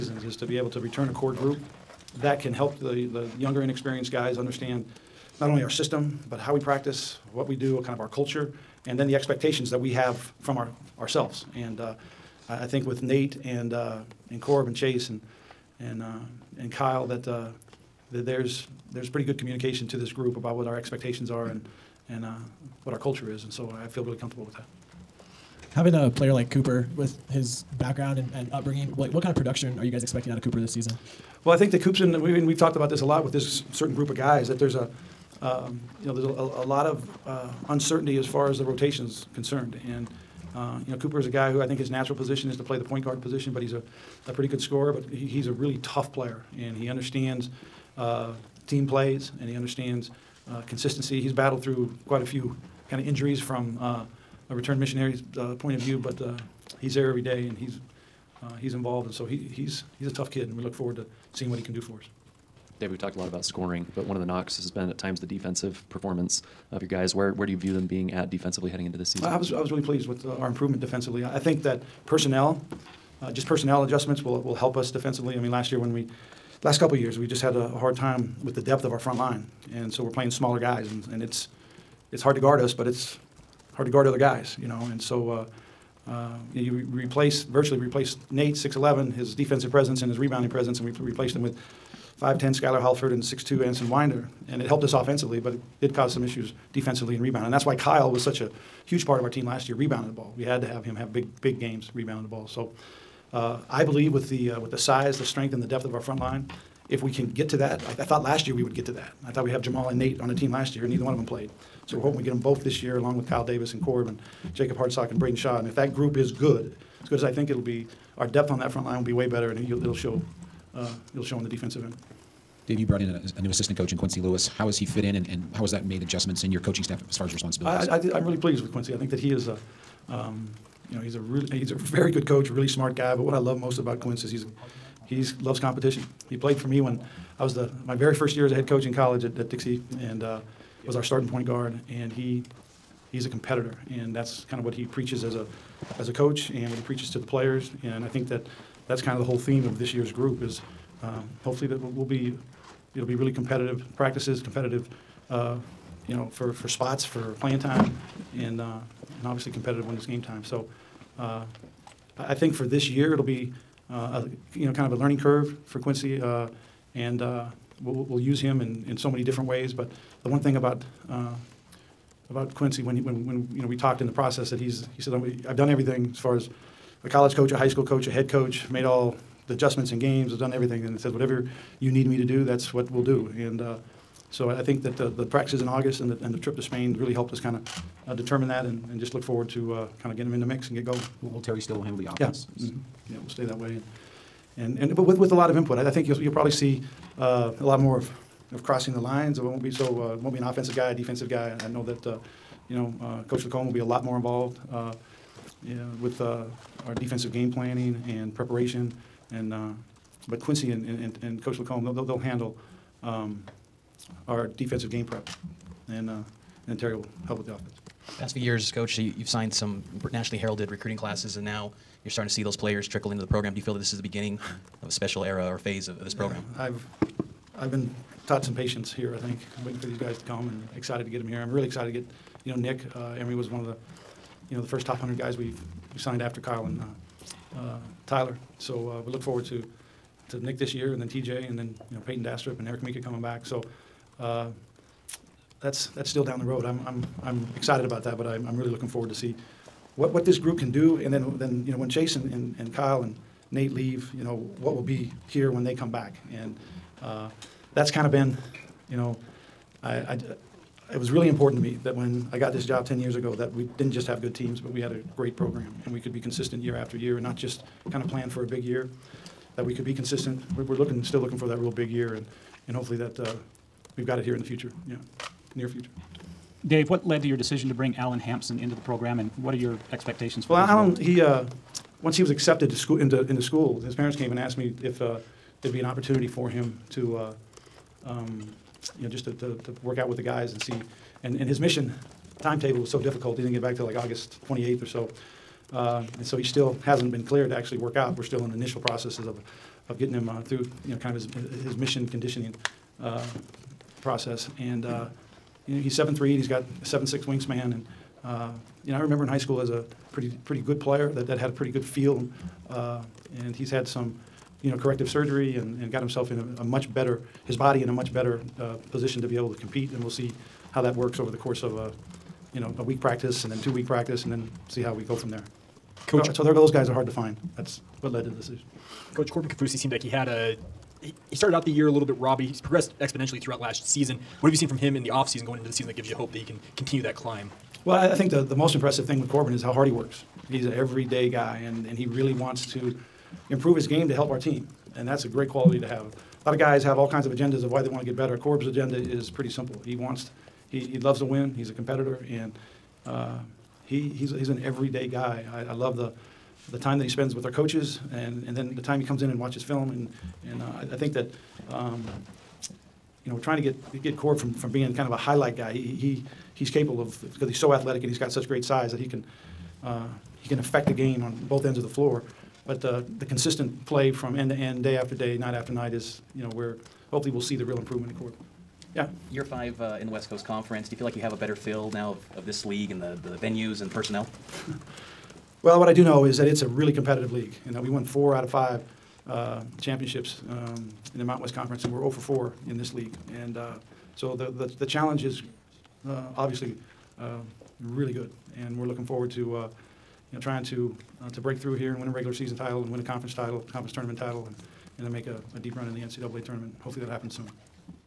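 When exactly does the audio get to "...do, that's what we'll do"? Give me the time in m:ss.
3:02.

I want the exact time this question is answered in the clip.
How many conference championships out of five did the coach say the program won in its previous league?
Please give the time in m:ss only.
6:28.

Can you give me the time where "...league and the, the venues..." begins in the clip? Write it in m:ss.
6:22.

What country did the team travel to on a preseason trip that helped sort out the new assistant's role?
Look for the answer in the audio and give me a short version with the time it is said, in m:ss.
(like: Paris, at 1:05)
Spain, at 3:06.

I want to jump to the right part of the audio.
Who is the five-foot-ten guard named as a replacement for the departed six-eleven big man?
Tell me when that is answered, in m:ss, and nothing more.
1:32.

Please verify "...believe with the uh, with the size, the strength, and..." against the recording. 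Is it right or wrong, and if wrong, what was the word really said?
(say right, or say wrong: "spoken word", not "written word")
right.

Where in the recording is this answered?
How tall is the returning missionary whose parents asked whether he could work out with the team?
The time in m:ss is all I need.
5:05.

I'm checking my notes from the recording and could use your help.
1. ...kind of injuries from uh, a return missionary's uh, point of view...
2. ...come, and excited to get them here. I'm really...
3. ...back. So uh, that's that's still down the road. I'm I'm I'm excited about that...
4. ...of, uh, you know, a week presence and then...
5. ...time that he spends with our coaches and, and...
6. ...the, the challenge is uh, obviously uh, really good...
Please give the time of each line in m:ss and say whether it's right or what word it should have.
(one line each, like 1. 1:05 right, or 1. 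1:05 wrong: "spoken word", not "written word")
1. 0:52 right
2. 3:50 right
3. 4:03 right
4. 5:21 wrong: "practice", not "presence"
5. 5:56 right
6. 6:34 right.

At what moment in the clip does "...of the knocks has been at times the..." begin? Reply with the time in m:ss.
1:04.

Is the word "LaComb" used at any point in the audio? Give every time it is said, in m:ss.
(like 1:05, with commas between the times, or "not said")
3:23, 3:31.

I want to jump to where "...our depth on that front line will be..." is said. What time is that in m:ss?
1:58.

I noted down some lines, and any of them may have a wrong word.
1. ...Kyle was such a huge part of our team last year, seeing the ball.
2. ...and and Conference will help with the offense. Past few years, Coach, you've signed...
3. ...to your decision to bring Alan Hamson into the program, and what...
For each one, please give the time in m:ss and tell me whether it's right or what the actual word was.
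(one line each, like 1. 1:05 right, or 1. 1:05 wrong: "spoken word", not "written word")
1. 1:37 wrong: "rebounding", not "seeing"
2. 3:35 wrong: "Terry", not "Conference"
3. 4:37 right.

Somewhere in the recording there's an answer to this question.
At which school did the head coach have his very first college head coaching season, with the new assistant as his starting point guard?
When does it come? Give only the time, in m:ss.
2:19.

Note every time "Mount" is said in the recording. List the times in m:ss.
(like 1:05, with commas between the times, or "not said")
6:31.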